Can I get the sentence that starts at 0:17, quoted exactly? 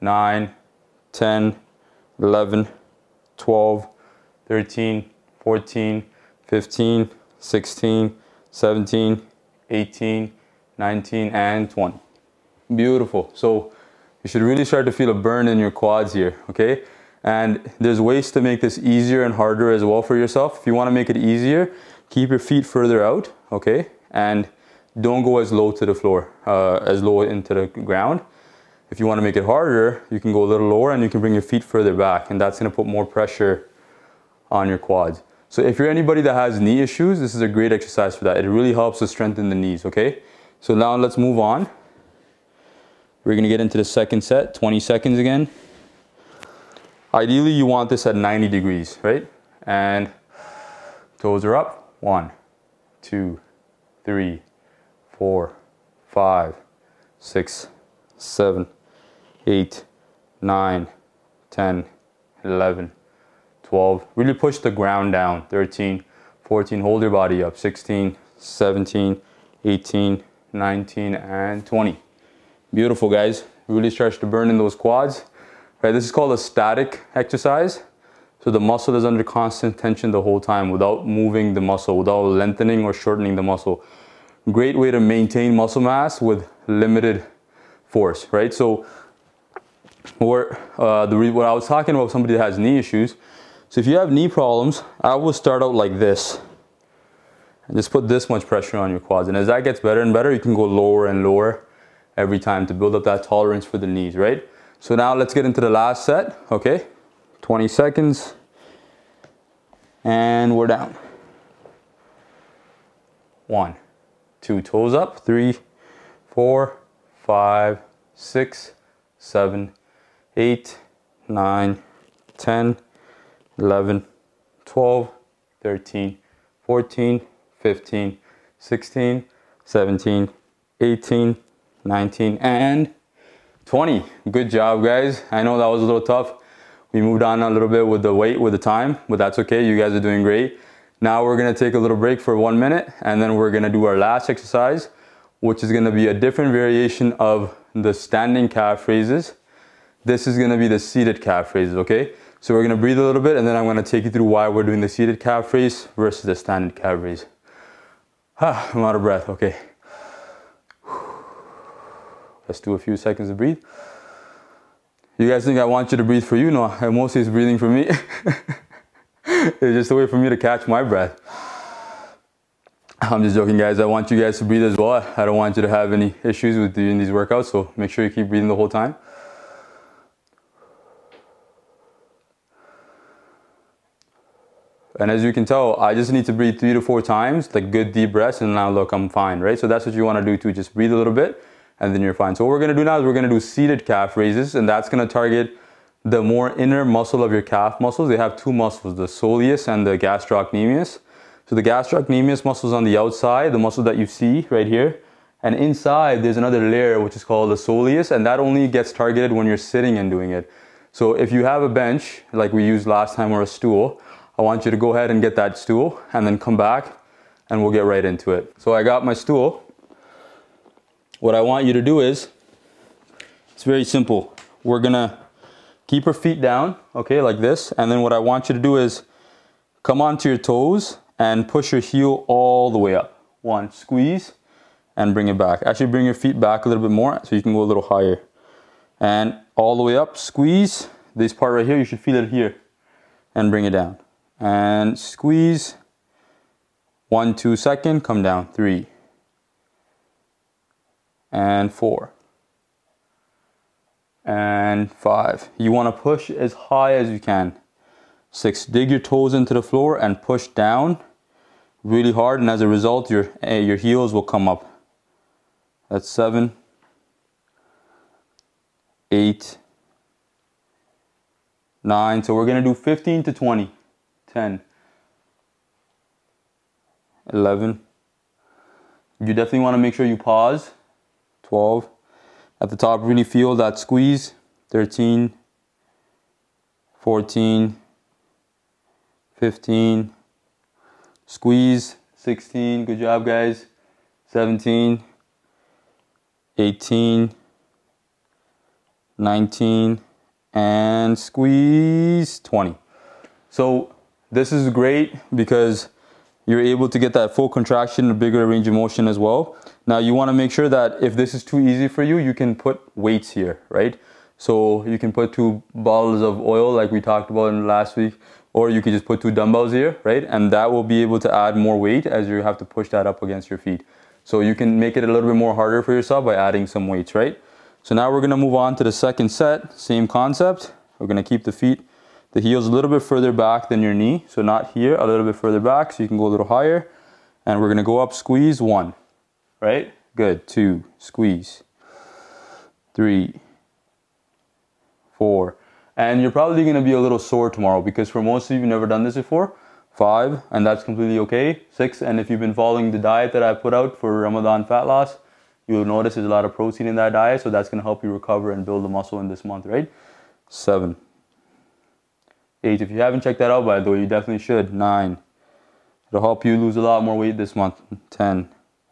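And there's ways to make this easier and harder as well for yourself.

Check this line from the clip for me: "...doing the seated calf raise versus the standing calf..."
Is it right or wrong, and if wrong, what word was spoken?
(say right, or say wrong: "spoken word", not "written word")
right.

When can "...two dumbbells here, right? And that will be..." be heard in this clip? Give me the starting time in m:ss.
5:19.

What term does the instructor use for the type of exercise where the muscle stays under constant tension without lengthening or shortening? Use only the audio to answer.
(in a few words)
Static exercise.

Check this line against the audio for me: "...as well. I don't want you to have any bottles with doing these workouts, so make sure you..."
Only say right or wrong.
wrong.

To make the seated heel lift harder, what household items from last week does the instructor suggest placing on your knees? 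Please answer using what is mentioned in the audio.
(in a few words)
Two bottles of oil.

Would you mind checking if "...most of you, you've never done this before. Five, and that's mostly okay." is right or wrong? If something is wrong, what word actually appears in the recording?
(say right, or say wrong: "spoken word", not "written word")
wrong: "completely", not "mostly".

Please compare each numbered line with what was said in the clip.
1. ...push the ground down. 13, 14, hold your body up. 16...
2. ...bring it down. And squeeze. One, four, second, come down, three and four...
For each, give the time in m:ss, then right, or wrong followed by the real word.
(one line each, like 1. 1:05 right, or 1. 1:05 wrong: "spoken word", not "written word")
1. 1:04 right
2. 4:03 wrong: "two", not "four".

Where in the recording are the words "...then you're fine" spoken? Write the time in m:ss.
3:11.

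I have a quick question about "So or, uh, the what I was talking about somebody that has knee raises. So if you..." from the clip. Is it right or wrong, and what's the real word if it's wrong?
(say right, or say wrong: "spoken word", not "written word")
wrong: "issues", not "raises".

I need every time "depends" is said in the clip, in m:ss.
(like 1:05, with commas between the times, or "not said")
not said.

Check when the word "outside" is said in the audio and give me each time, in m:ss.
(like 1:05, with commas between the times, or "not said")
3:22.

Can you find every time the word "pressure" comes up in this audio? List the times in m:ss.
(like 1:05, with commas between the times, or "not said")
0:33, 1:38.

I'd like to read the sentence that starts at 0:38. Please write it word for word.
It really helps to strengthen the knees, okay?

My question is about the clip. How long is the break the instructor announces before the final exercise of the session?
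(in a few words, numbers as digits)
1 minute.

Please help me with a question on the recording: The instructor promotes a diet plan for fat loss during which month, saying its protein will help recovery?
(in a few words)
Ramadan.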